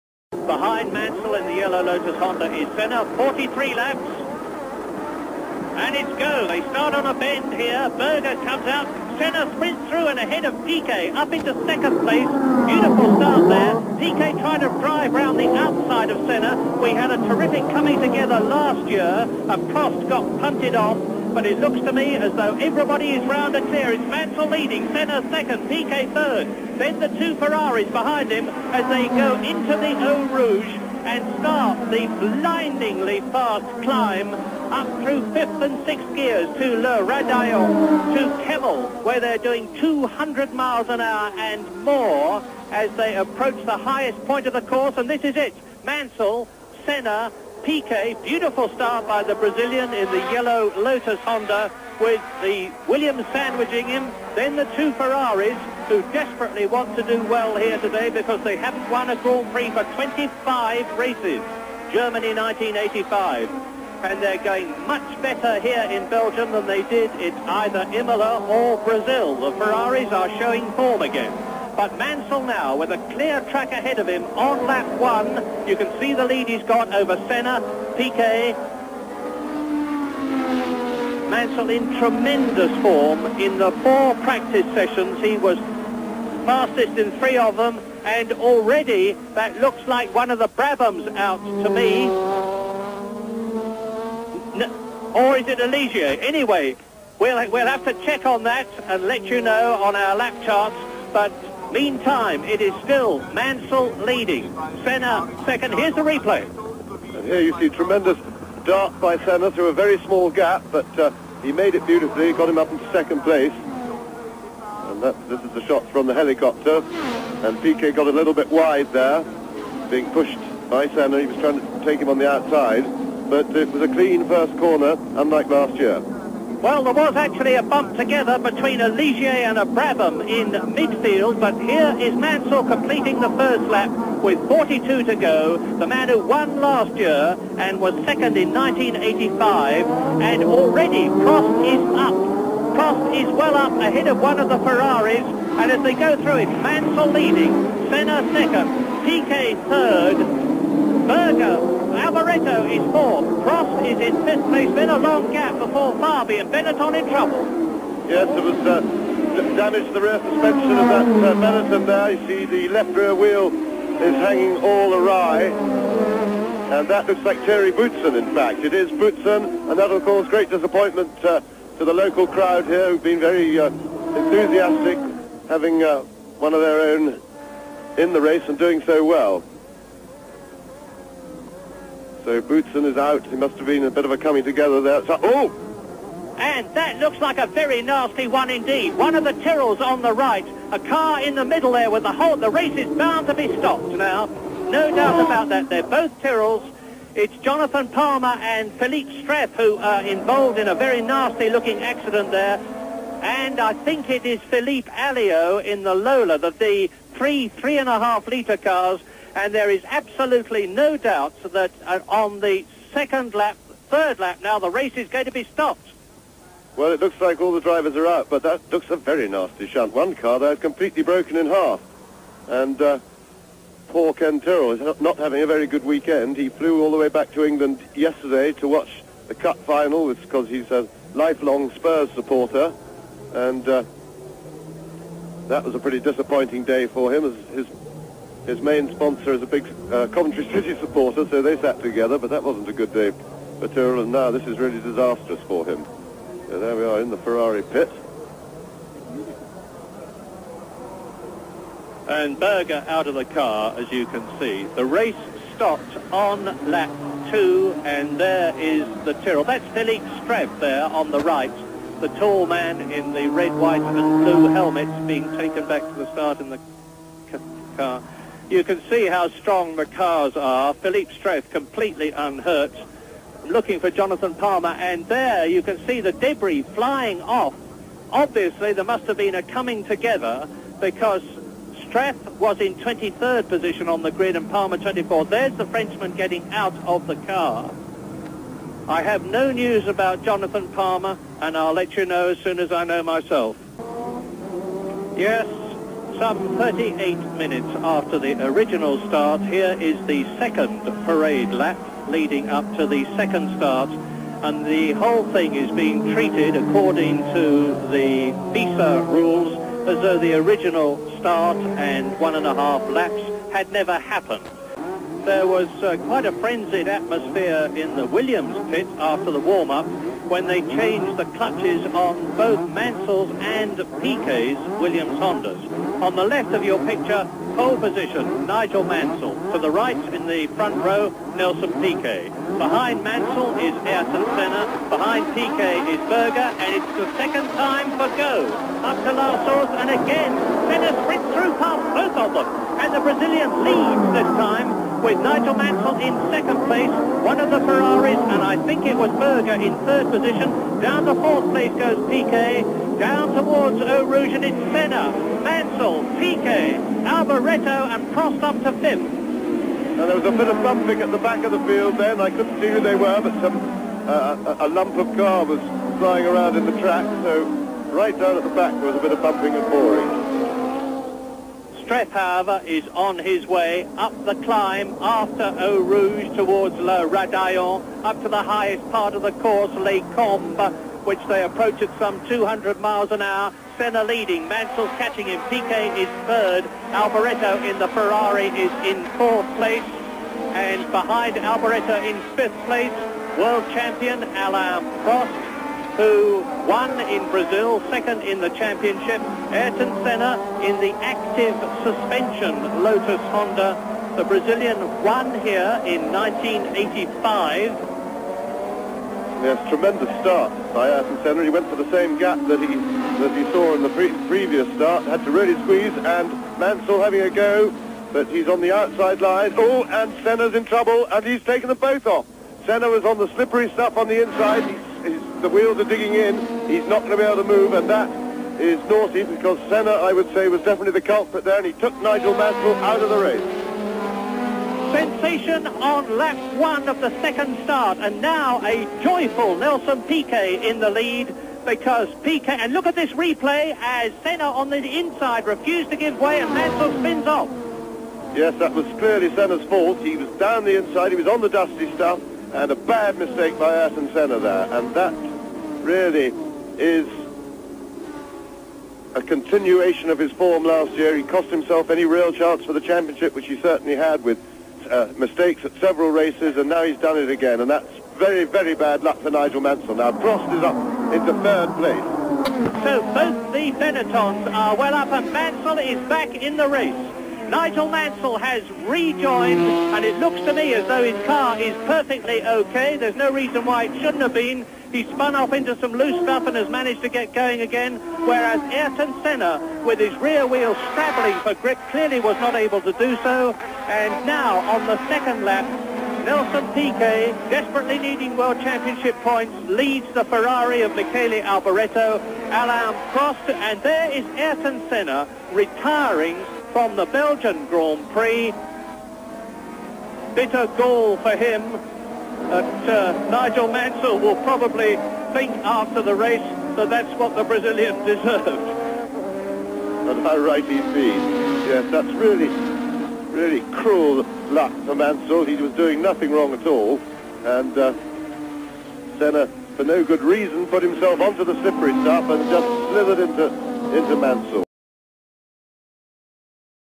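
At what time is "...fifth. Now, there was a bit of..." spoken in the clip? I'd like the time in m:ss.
5:58.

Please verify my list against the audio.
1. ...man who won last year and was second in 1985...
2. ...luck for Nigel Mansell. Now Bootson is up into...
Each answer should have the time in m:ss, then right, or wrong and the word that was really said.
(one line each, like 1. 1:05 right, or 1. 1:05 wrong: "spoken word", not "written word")
1. 2:15 right
2. 7:49 wrong: "Prost", not "Bootson".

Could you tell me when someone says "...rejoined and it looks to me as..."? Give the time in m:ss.
7:58.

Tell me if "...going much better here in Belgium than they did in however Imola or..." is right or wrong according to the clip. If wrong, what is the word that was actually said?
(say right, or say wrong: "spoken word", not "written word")
wrong: "either", not "however".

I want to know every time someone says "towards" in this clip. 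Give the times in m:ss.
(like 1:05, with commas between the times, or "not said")
5:53, 6:16.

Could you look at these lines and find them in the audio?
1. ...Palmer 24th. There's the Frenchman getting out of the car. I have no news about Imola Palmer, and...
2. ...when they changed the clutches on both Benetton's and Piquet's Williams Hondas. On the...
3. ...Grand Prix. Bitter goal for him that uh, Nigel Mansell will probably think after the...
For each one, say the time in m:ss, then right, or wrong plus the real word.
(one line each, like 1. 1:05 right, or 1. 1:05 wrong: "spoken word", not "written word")
1. 4:44 wrong: "Jonathan", not "Imola"
2. 5:20 wrong: "Mansell", not "Benetton"
3. 8:27 right.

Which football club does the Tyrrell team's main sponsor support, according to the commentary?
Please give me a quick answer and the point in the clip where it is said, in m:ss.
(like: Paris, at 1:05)
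Coventry City, at 4:00.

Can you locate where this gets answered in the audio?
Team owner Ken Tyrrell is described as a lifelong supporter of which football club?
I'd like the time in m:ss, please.
3:51.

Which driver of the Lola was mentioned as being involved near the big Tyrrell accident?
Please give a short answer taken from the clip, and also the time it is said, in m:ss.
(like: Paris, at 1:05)
Philippe Alliot, at 3:24.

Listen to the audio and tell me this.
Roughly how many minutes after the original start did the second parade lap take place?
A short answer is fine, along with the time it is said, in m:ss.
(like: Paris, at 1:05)
38, at 4:56.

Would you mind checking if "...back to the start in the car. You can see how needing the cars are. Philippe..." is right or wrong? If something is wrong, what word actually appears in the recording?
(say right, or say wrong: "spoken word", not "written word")
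wrong: "strong", not "needing".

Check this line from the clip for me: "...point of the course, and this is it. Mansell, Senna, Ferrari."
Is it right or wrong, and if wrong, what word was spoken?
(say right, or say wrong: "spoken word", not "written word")
wrong: "Piquet", not "Ferrari".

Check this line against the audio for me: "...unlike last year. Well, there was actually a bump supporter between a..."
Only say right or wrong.
wrong.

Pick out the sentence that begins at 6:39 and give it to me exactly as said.
Ayrton Senna in the active suspension Lotus Honda.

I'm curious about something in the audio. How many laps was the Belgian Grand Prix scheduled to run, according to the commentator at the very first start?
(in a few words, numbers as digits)
43.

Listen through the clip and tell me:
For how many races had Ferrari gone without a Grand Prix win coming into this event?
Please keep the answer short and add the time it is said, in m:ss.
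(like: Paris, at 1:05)
25, at 0:59.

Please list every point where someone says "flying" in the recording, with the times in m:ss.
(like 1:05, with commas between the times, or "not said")
4:36, 6:05.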